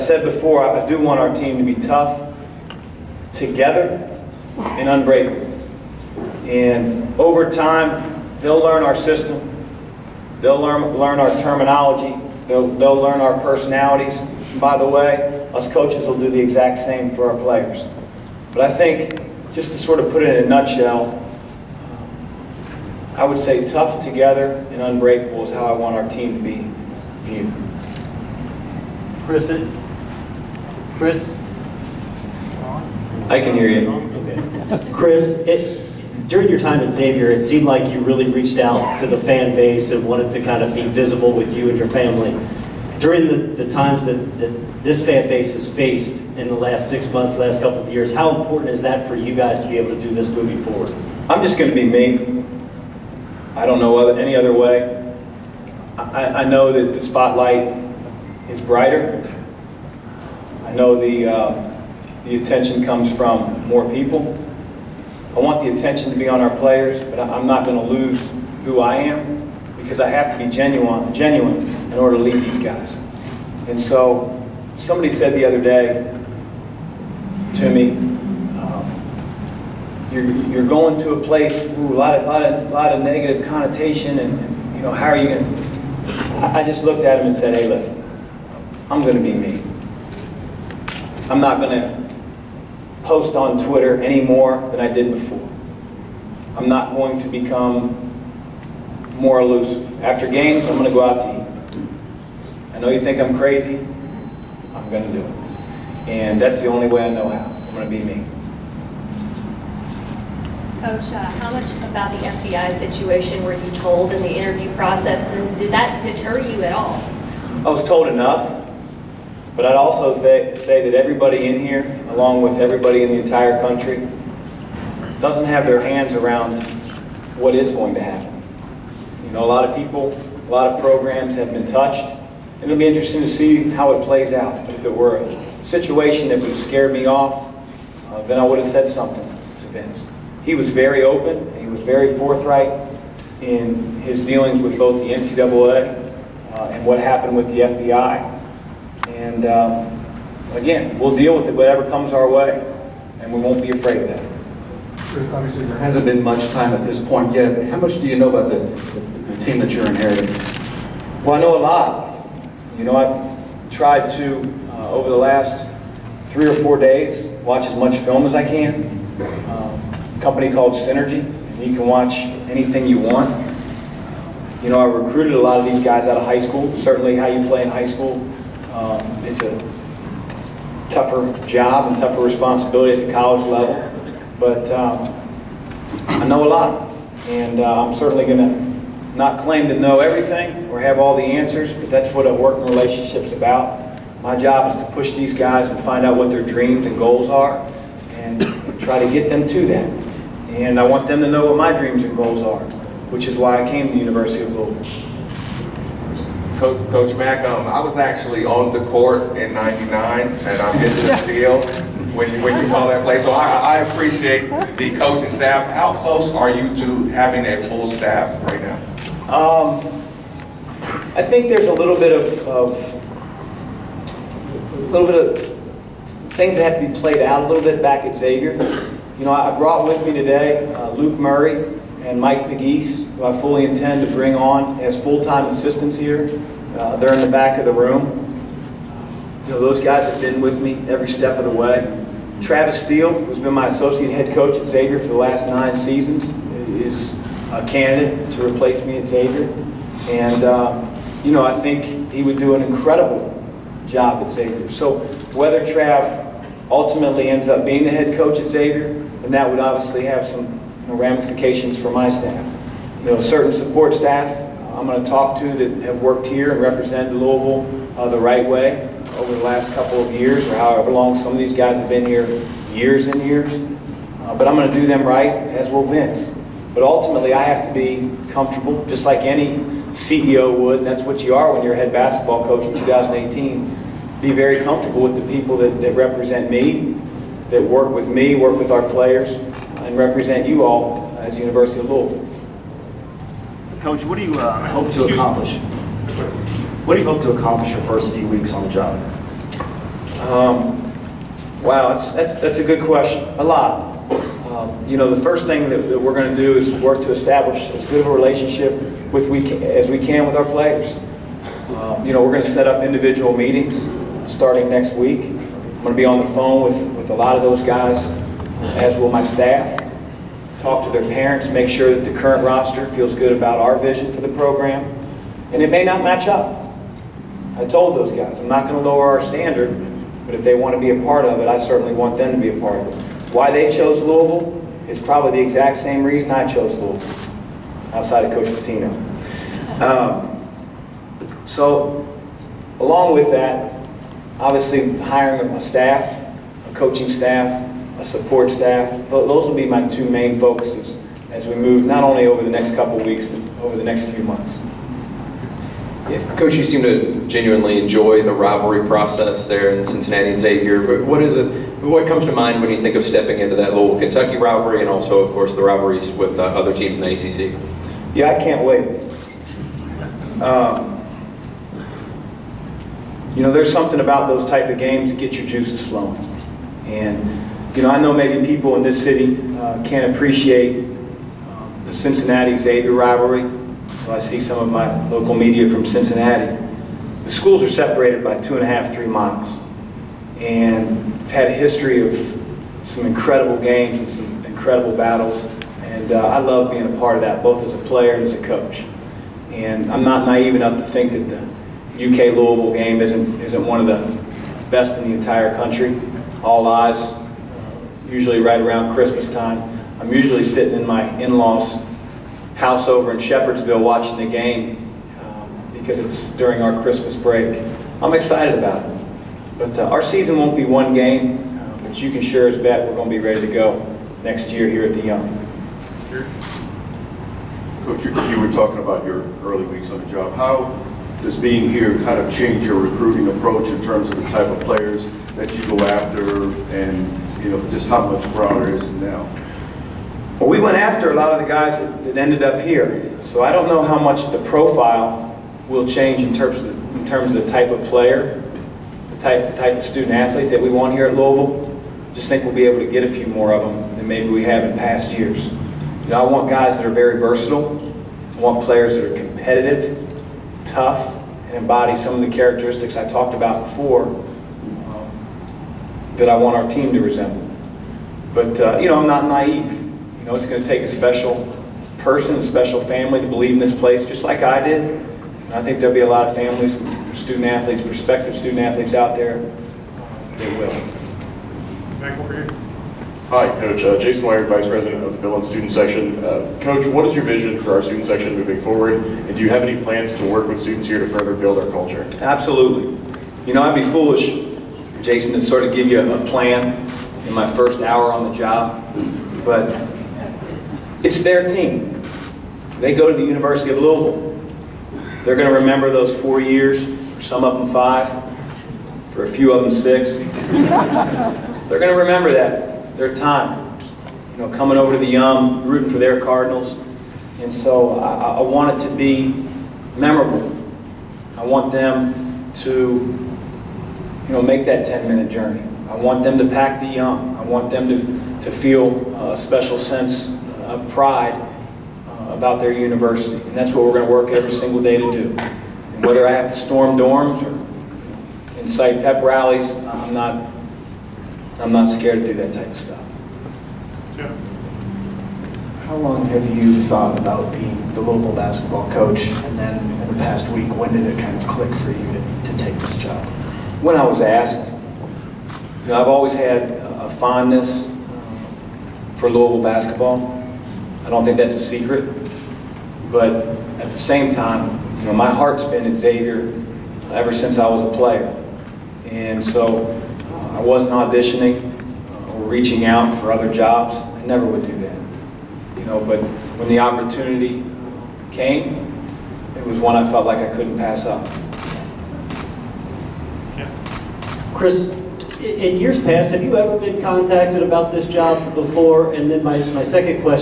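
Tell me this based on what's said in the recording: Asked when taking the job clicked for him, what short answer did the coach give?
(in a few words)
When I was asked.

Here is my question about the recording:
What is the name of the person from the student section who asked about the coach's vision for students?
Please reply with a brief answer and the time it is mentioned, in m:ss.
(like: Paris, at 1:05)
Jason Wire, at 8:03.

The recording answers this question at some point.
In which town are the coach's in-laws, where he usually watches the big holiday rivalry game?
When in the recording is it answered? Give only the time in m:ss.
6:53.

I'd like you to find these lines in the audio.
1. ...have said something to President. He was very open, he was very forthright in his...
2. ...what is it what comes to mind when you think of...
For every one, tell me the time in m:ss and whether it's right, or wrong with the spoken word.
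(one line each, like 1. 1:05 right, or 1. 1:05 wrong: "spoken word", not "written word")
1. 2:18 wrong: "Vince", not "President"
2. 6:01 right.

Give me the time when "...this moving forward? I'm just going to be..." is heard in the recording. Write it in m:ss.
0:50.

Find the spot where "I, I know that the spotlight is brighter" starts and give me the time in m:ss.
0:55.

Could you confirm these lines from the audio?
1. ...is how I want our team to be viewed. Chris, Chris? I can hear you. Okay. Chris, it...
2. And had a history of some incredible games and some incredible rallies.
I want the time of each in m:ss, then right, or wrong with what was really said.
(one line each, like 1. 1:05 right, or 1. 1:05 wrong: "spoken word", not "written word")
1. 0:25 right
2. 6:30 wrong: "battles", not "rallies".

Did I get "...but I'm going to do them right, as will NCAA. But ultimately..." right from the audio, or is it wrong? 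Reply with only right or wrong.
wrong.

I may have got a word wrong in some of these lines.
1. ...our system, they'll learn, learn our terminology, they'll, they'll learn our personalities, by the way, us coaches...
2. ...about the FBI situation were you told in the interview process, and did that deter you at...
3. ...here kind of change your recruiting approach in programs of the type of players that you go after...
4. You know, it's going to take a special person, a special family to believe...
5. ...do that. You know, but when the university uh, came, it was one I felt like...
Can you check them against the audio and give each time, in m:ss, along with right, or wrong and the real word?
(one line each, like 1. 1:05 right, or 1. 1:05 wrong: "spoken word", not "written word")
1. 0:08 right
2. 1:51 right
3. 7:11 wrong: "terms", not "programs"
4. 7:49 right
5. 9:34 wrong: "opportunity", not "university".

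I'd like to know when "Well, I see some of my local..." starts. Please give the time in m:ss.
6:24.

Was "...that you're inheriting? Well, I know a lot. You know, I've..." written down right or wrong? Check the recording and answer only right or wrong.
right.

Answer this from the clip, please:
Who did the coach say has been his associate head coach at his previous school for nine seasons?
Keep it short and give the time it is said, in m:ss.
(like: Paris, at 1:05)
Travis Steele, at 4:02.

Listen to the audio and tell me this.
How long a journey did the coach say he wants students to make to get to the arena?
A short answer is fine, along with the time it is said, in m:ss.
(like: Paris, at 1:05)
10 minutes, at 8:44.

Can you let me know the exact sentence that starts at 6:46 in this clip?
All eyes, uh, usually right around Christmas time.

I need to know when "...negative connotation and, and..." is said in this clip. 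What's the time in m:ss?
1:23.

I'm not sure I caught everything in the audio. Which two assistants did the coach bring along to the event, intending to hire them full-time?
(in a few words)
Luke Murray and Mike Pegues.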